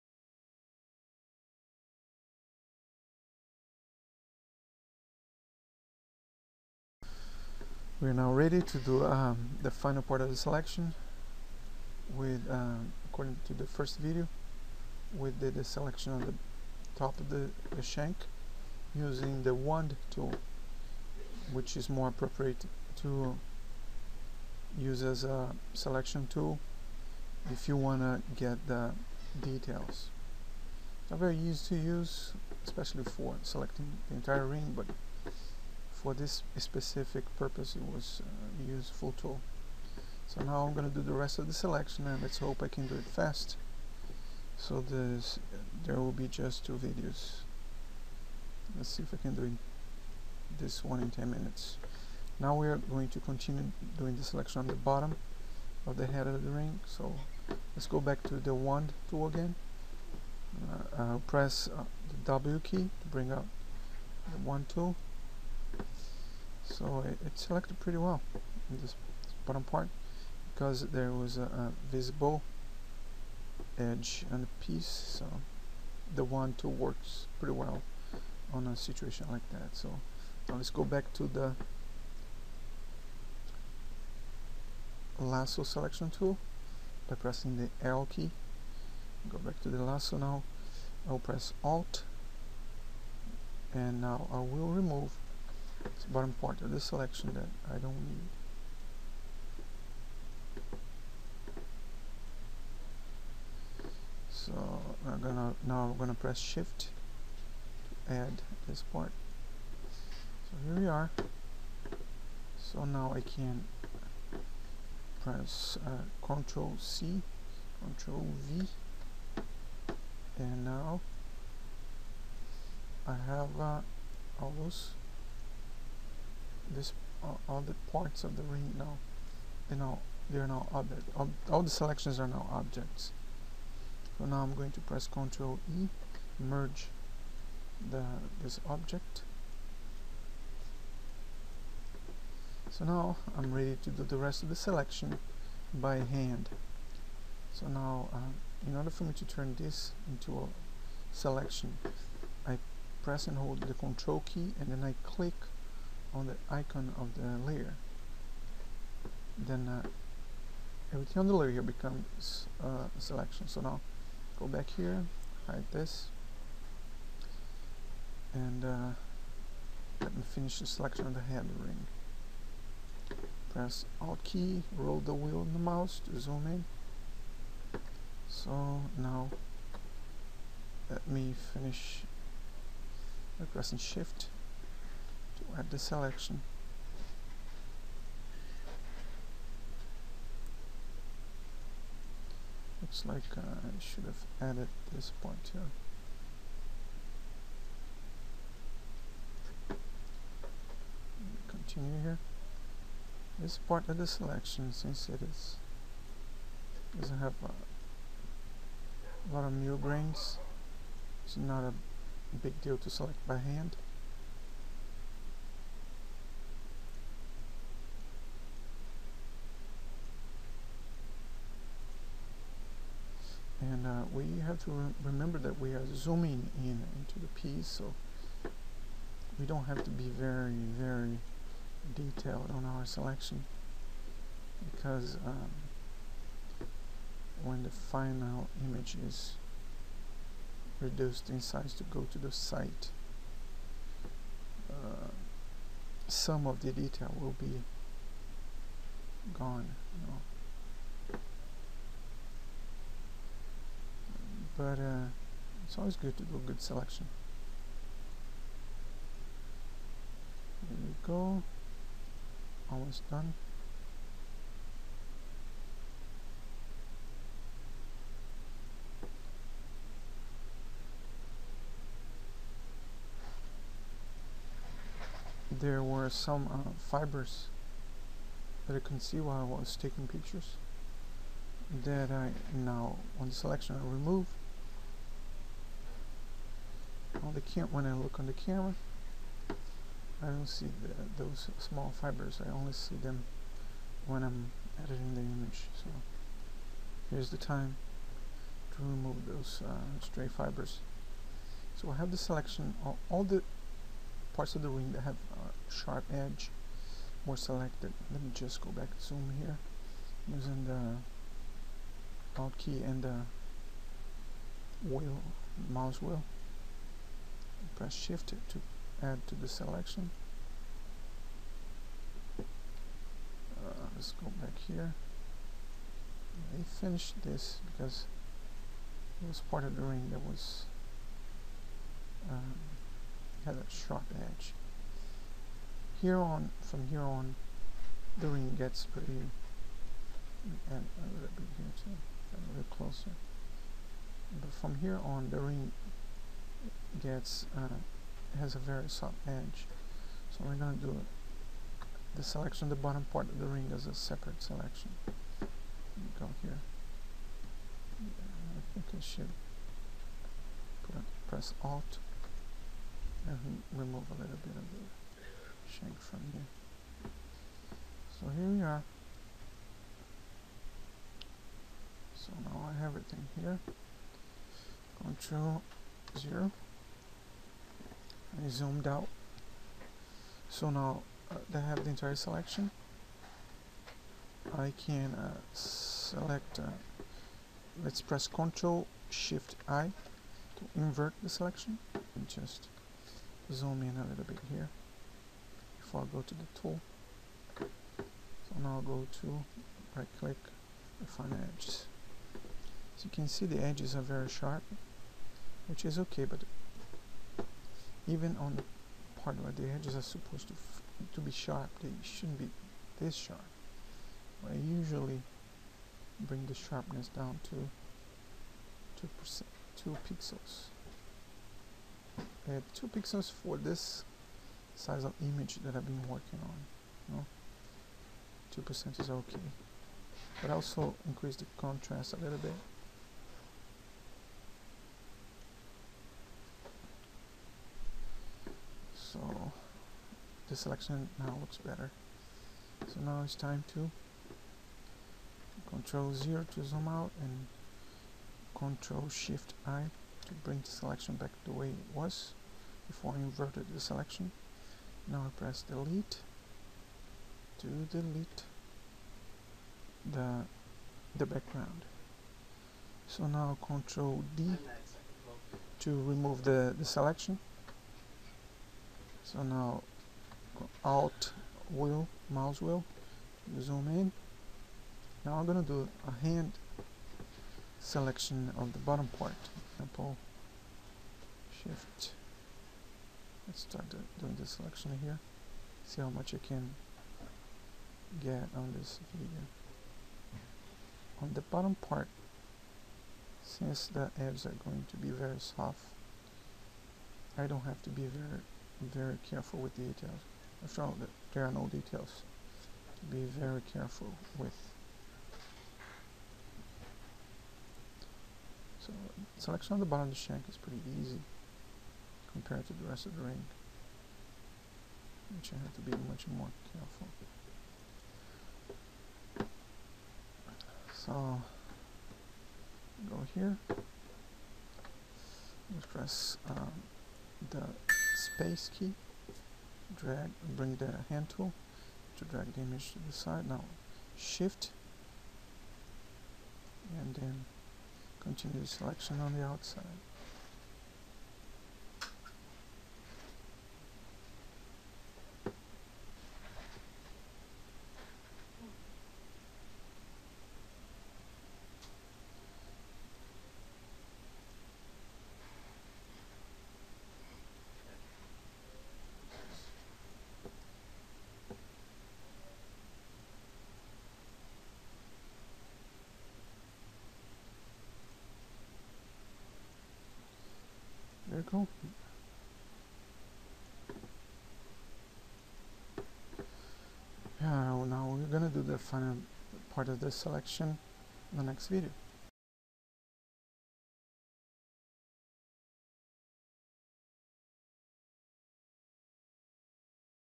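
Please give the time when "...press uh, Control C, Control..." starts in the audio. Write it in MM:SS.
01:55.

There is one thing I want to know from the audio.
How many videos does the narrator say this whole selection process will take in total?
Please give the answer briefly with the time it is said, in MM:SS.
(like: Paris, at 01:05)
2, at 00:46.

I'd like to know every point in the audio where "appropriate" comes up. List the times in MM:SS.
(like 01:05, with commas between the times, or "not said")
00:22.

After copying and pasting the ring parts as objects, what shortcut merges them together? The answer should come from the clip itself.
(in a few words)
Ctrl E.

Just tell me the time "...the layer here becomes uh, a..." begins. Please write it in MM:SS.
02:41.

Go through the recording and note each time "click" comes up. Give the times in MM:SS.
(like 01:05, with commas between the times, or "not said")
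02:35, 06:40.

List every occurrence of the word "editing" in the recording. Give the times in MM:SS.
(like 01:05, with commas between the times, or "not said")
04:54.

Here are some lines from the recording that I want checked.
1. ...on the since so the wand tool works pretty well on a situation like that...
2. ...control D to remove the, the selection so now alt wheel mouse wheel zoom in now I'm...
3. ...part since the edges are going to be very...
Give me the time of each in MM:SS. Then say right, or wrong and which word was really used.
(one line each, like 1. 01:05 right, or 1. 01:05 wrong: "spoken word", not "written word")
1. 01:14 wrong: "piece", not "since"
2. 07:43 right
3. 08:11 right.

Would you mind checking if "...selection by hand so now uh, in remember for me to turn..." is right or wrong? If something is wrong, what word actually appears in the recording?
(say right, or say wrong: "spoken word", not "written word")
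wrong: "order", not "remember".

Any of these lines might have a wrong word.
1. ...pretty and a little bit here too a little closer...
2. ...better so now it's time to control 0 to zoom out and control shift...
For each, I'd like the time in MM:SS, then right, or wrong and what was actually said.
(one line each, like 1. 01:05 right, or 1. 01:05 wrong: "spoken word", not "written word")
1. 05:38 right
2. 07:21 right.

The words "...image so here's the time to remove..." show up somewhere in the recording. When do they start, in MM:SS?
04:55.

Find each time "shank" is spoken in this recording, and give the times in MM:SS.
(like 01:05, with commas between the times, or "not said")
00:17, 06:05, 08:30.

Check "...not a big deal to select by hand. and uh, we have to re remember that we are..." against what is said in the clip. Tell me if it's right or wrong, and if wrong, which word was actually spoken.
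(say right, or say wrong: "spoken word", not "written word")
right.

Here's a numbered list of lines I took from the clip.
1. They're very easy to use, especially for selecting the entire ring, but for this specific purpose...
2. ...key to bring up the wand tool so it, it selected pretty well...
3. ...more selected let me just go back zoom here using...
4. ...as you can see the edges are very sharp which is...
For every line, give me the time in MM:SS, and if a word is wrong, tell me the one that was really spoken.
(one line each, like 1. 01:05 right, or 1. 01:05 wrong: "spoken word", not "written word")
1. 00:31 right
2. 01:02 right
3. 05:07 right
4. 06:42 right.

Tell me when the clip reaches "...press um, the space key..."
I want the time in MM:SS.
08:45.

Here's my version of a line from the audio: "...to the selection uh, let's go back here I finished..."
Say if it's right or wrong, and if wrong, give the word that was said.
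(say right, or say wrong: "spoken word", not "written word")
right.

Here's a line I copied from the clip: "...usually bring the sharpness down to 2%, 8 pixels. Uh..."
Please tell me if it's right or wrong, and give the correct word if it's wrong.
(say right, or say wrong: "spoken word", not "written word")
wrong: "2", not "8".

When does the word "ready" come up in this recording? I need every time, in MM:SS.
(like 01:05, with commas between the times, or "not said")
00:08, 02:23.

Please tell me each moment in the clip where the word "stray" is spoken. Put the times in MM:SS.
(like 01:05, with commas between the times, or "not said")
05:00.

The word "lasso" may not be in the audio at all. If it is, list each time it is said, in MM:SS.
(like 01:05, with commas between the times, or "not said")
01:25, 01:29.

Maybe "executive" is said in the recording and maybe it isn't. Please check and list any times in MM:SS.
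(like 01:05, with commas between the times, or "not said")
not said.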